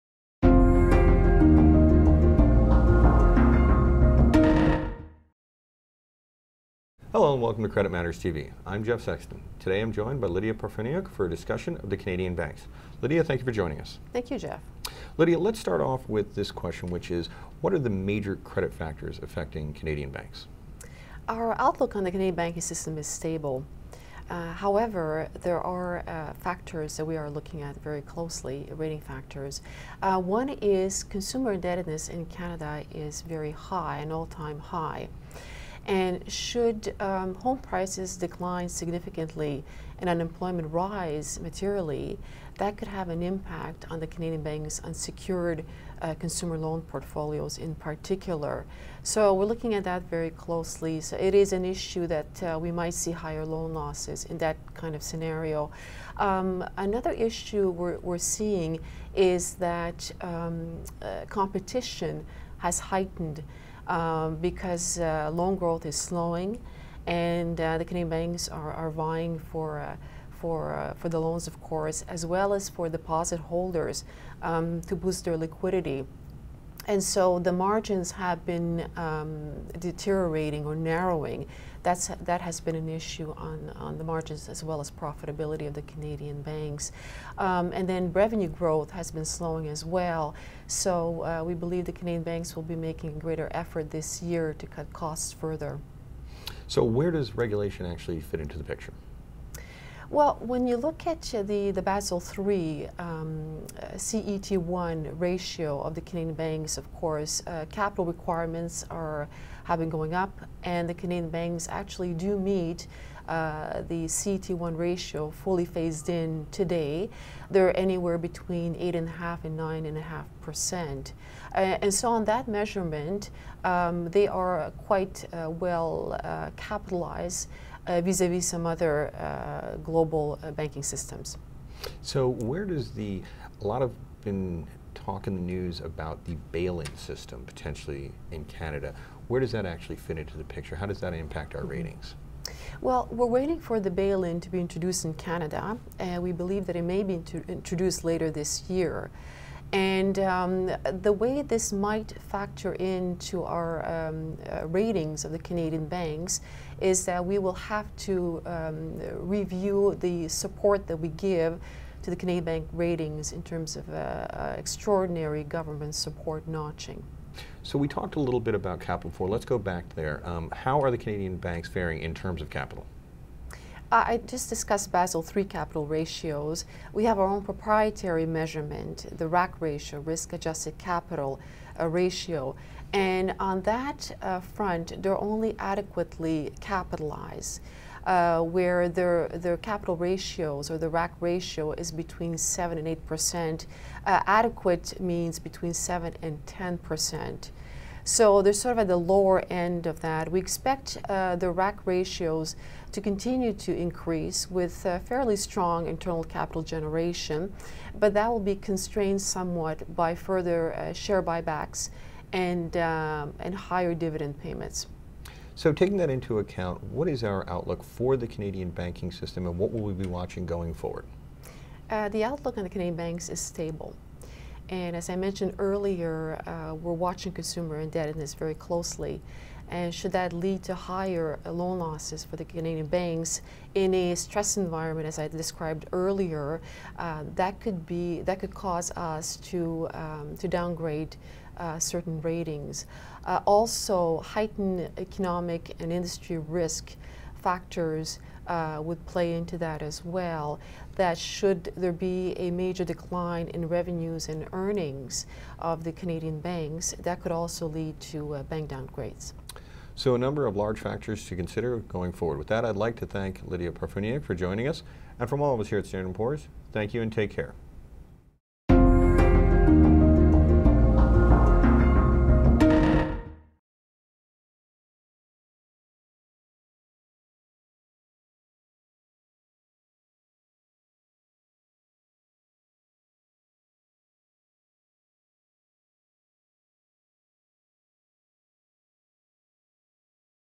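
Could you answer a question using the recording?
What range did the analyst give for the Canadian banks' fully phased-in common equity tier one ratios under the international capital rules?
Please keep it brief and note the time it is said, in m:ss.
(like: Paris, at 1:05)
8.5 and 9.5%, at 1:58.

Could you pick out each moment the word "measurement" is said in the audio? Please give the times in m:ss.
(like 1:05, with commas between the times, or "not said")
2:02, 2:58.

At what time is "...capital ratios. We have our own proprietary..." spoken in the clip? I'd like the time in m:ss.
2:55.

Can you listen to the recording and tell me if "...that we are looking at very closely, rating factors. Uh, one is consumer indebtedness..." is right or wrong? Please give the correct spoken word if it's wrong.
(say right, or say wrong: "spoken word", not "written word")
right.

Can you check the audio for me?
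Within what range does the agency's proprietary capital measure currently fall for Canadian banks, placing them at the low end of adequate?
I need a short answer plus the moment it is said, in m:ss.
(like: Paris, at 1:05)
7 and 8 percent, at 3:12.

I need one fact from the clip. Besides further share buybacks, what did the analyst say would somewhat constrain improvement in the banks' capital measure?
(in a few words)
higher dividend payments.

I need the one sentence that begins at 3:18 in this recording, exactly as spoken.
So they're sort of at the lower end of that.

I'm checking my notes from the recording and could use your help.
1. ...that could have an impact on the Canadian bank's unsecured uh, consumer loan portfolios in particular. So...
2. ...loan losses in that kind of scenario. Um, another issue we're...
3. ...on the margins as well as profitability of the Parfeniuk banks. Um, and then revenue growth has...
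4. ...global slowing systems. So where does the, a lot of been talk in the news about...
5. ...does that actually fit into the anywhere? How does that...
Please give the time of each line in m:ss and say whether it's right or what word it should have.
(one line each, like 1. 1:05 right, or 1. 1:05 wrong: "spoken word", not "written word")
1. 0:42 right
2. 0:53 right
3. 1:23 wrong: "Canadian", not "Parfeniuk"
4. 2:09 wrong: "banking", not "slowing"
5. 2:19 wrong: "picture", not "anywhere".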